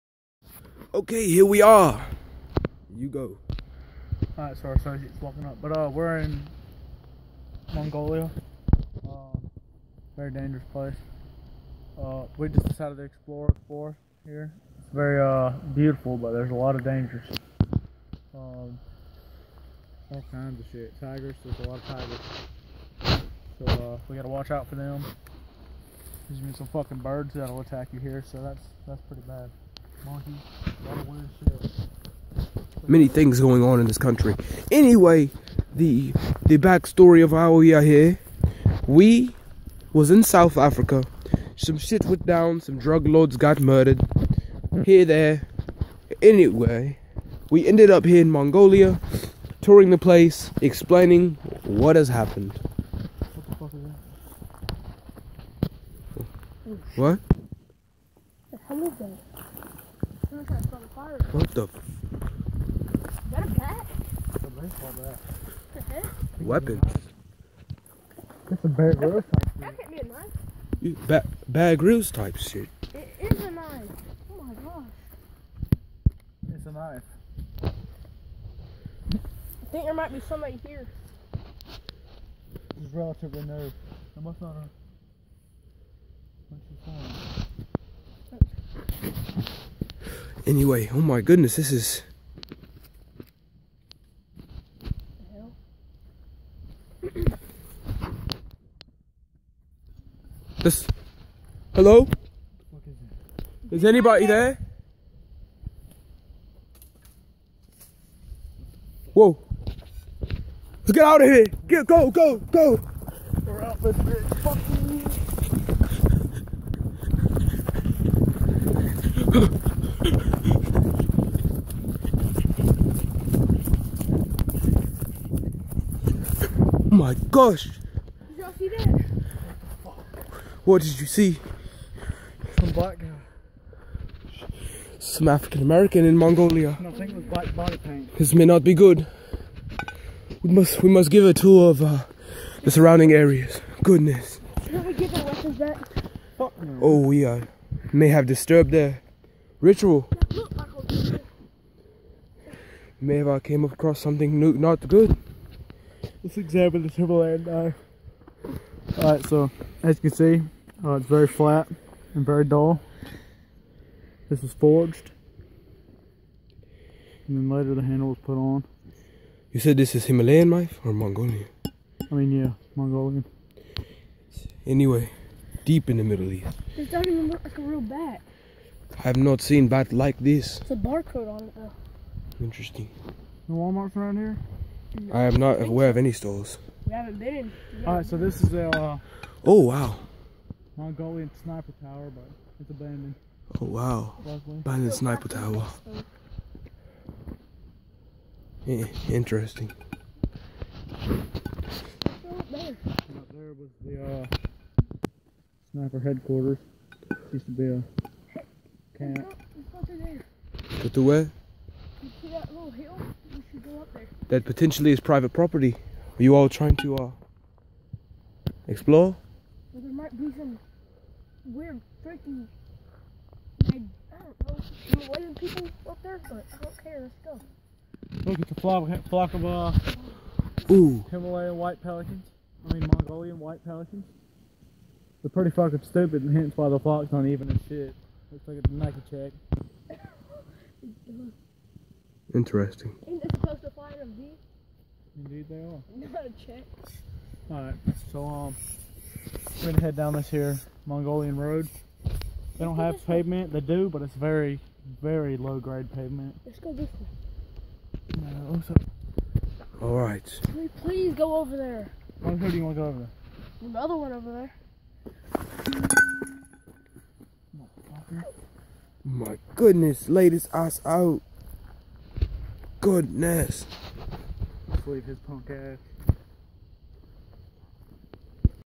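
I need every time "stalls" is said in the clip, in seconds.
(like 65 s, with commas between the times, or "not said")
186 s.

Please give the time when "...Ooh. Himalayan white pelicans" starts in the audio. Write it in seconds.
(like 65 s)
230 s.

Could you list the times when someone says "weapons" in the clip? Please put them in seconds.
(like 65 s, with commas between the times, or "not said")
66 s, 145 s.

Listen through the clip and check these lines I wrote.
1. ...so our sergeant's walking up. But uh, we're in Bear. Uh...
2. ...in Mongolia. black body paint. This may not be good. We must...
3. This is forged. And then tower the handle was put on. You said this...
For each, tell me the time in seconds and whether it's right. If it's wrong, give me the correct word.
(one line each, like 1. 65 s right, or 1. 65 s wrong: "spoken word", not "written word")
1. 4 s wrong: "Mongolia", not "Bear"
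2. 136 s right
3. 164 s wrong: "later", not "tower".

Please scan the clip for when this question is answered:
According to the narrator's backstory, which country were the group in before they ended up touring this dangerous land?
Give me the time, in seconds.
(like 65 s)
40 s.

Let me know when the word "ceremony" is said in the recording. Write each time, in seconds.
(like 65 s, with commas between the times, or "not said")
not said.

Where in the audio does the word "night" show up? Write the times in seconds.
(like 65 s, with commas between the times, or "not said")
not said.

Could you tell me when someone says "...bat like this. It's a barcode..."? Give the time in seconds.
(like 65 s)
179 s.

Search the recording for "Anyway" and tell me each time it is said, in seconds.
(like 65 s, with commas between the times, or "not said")
34 s, 46 s, 90 s, 174 s.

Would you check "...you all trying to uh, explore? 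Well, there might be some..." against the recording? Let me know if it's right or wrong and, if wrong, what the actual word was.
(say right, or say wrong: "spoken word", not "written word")
right.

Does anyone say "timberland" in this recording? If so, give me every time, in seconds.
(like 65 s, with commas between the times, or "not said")
156 s.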